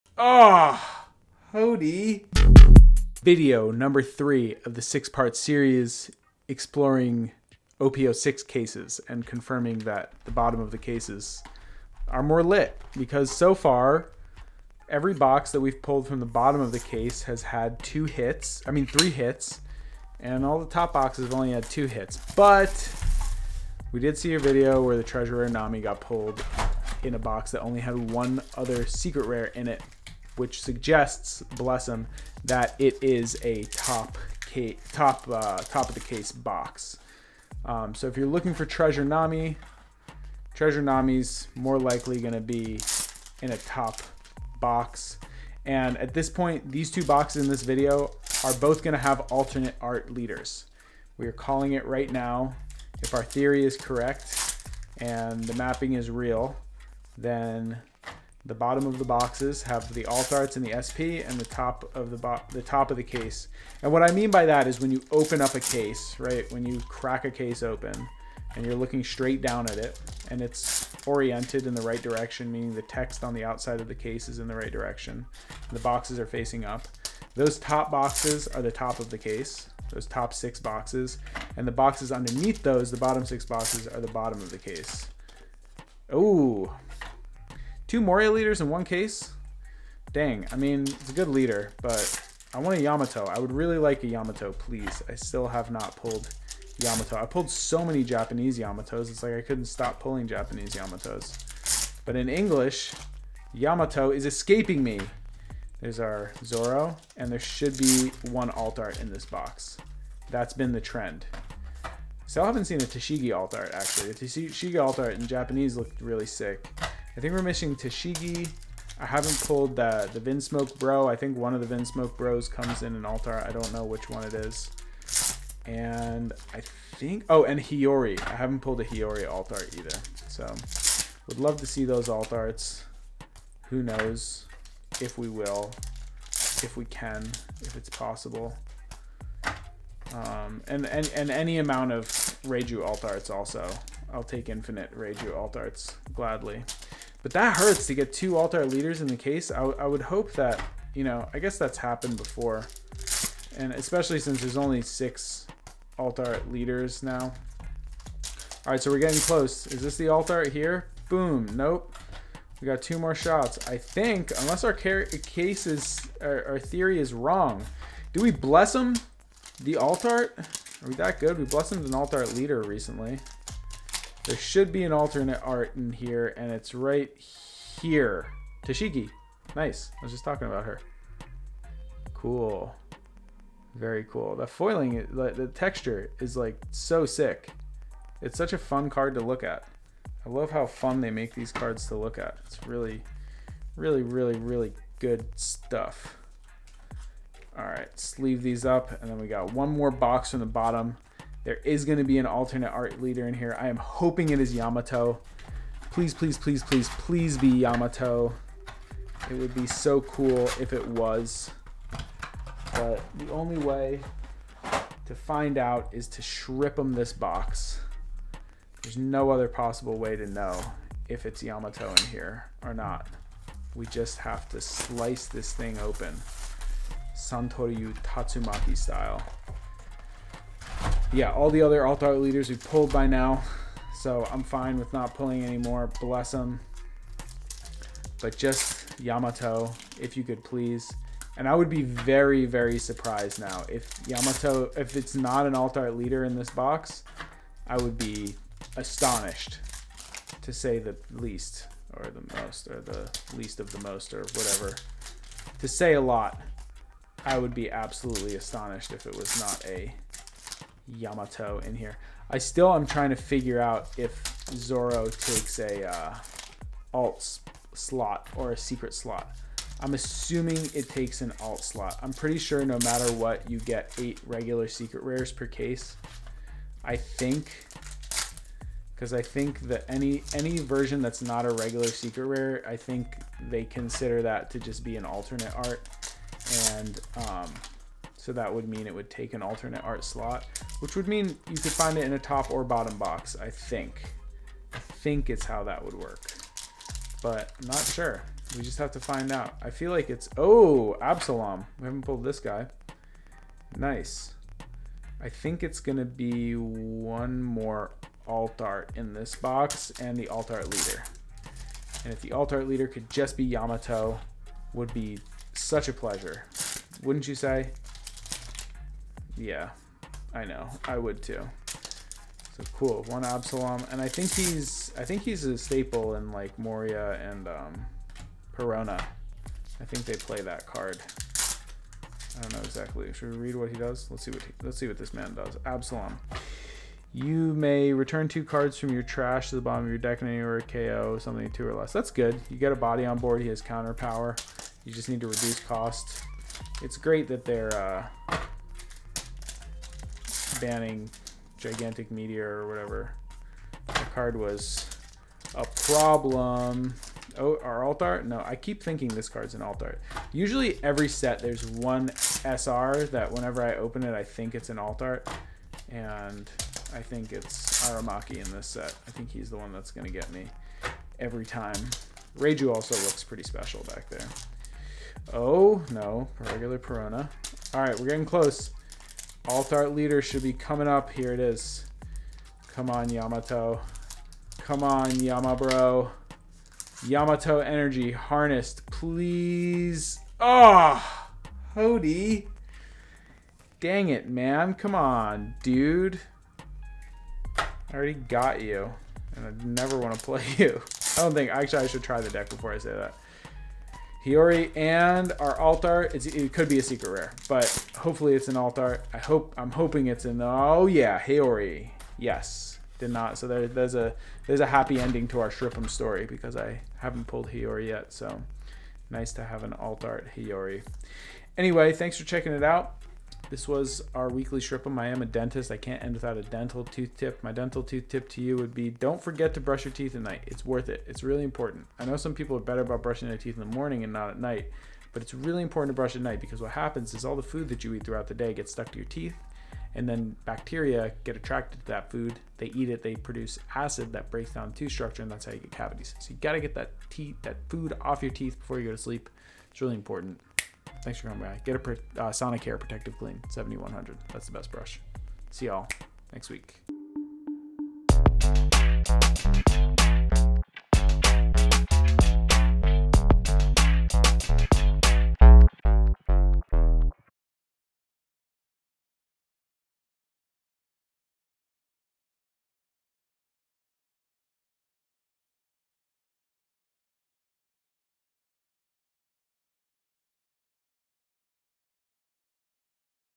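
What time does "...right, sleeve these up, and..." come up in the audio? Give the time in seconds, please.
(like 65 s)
197 s.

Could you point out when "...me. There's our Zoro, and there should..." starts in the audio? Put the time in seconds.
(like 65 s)
104 s.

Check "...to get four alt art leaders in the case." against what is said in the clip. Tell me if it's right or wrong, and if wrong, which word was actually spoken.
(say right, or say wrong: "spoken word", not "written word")
wrong: "two", not "four".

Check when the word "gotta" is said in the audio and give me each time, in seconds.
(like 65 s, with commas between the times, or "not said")
446 s.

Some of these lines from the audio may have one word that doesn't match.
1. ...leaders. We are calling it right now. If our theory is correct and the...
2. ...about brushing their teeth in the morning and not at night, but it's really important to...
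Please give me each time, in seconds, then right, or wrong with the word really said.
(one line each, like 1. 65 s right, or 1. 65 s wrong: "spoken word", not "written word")
1. 50 s right
2. 432 s right.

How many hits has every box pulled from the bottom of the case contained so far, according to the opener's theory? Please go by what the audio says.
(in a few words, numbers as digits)
3.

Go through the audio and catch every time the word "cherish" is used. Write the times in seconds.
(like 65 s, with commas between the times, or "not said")
not said.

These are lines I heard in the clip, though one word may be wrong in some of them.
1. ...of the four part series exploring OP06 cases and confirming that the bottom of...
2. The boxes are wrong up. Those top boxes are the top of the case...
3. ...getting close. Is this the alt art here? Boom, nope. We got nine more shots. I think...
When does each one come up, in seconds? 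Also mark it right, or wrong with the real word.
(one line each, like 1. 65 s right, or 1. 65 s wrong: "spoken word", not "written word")
1. 4 s wrong: "six", not "four"
2. 75 s wrong: "facing", not "wrong"
3. 158 s wrong: "two", not "nine".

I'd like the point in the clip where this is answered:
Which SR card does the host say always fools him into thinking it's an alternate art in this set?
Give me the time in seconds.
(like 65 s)
367 s.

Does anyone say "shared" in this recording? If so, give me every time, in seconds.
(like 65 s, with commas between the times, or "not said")
not said.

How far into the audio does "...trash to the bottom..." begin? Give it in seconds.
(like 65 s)
339 s.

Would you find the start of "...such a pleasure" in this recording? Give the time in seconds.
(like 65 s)
315 s.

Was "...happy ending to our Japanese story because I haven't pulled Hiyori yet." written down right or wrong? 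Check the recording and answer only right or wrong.
wrong.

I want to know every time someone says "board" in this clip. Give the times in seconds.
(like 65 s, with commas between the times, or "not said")
343 s.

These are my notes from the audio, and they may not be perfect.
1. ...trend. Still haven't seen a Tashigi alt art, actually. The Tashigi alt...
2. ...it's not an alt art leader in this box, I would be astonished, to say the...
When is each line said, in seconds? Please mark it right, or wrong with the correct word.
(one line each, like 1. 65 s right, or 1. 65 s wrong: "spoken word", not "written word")
1. 110 s right
2. 244 s right.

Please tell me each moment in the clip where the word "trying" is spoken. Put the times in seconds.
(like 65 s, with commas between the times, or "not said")
262 s.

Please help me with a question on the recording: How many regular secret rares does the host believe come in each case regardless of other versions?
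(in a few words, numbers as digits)
8.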